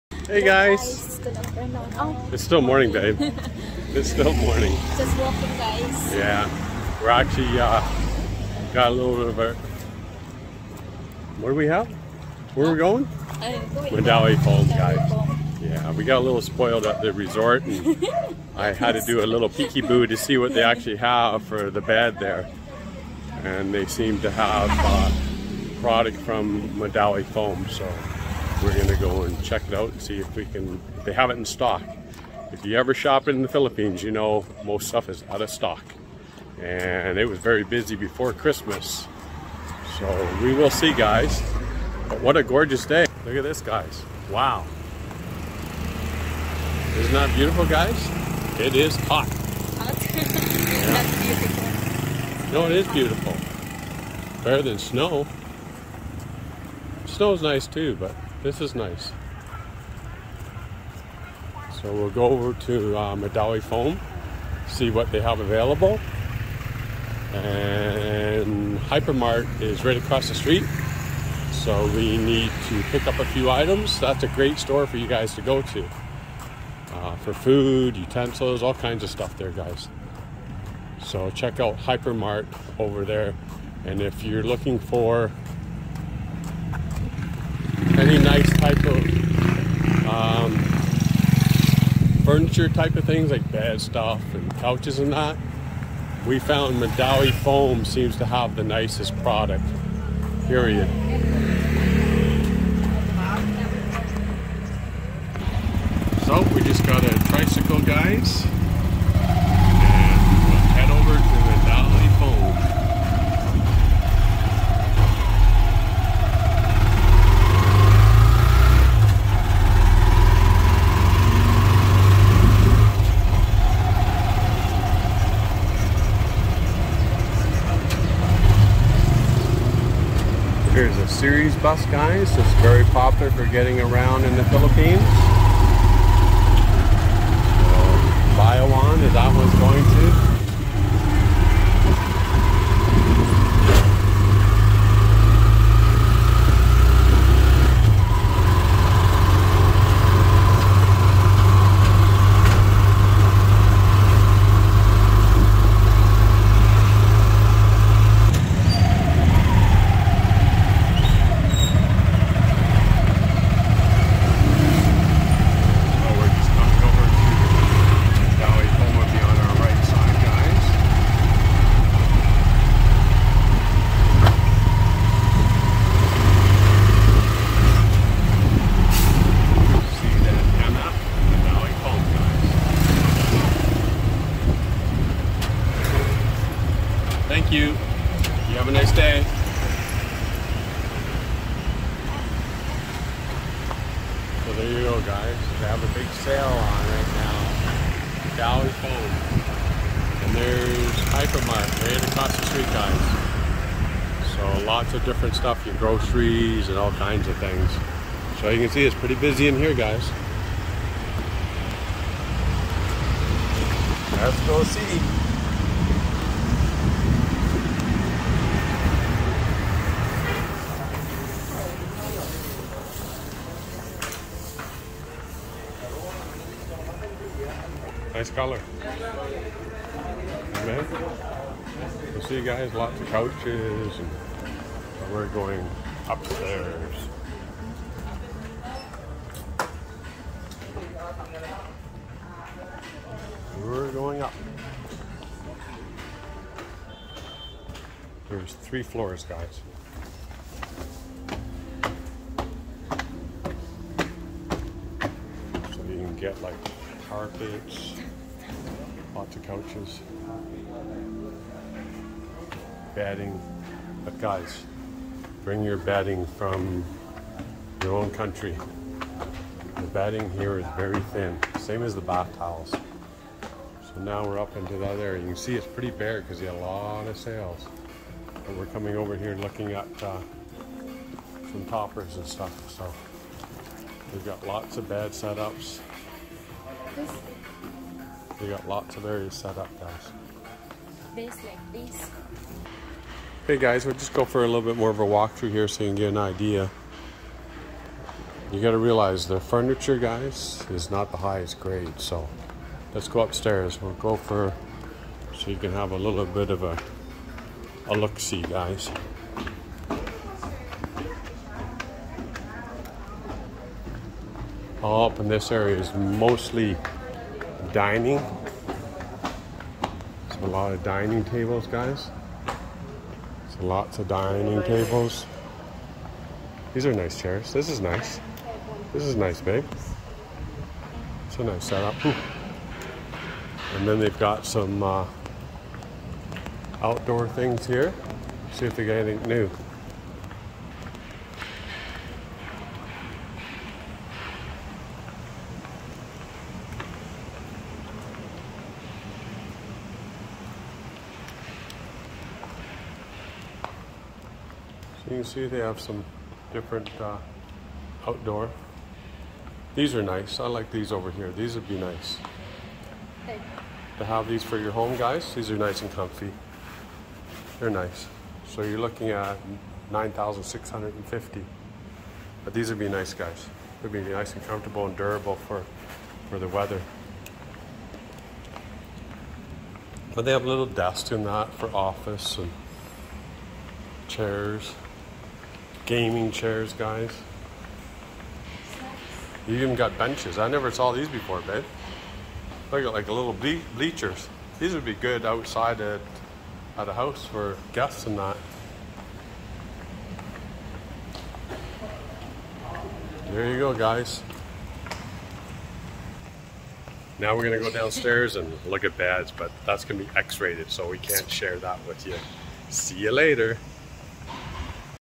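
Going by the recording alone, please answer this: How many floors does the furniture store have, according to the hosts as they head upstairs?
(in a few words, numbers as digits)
3.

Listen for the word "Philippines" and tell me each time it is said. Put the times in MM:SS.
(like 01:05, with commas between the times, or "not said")
00:33, 02:14.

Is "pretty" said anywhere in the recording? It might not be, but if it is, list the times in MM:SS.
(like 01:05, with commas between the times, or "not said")
03:28, 04:35.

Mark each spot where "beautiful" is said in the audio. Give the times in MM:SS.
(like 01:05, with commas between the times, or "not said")
00:47, 00:52.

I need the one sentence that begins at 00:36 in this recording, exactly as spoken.
And it was very busy before Christmas.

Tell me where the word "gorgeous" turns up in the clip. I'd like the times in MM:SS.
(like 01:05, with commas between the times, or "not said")
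00:42.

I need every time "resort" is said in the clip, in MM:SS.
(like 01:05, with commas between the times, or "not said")
00:17.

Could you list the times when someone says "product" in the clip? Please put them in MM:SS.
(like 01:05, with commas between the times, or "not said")
00:25, 01:39.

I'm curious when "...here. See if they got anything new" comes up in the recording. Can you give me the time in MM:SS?
05:37.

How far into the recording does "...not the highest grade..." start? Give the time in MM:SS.
05:00.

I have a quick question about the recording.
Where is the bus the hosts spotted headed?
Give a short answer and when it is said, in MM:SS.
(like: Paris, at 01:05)
Bayawan, at 02:18.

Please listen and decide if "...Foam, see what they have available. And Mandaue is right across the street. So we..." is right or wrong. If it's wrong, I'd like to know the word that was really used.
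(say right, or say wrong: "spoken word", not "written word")
wrong: "Hypermart", not "Mandaue".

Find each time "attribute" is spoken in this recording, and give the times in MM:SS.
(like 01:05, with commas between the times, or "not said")
not said.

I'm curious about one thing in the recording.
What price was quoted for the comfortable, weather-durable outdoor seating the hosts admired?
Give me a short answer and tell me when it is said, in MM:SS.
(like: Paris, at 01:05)
9,650, at 06:09.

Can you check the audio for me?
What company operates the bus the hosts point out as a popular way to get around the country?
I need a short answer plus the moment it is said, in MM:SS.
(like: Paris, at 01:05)
Ceres, at 02:11.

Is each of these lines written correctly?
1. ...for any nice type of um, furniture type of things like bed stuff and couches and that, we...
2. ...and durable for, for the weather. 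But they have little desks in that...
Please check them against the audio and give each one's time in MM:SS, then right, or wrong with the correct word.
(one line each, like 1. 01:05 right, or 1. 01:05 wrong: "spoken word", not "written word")
1. 01:24 right
2. 06:14 right.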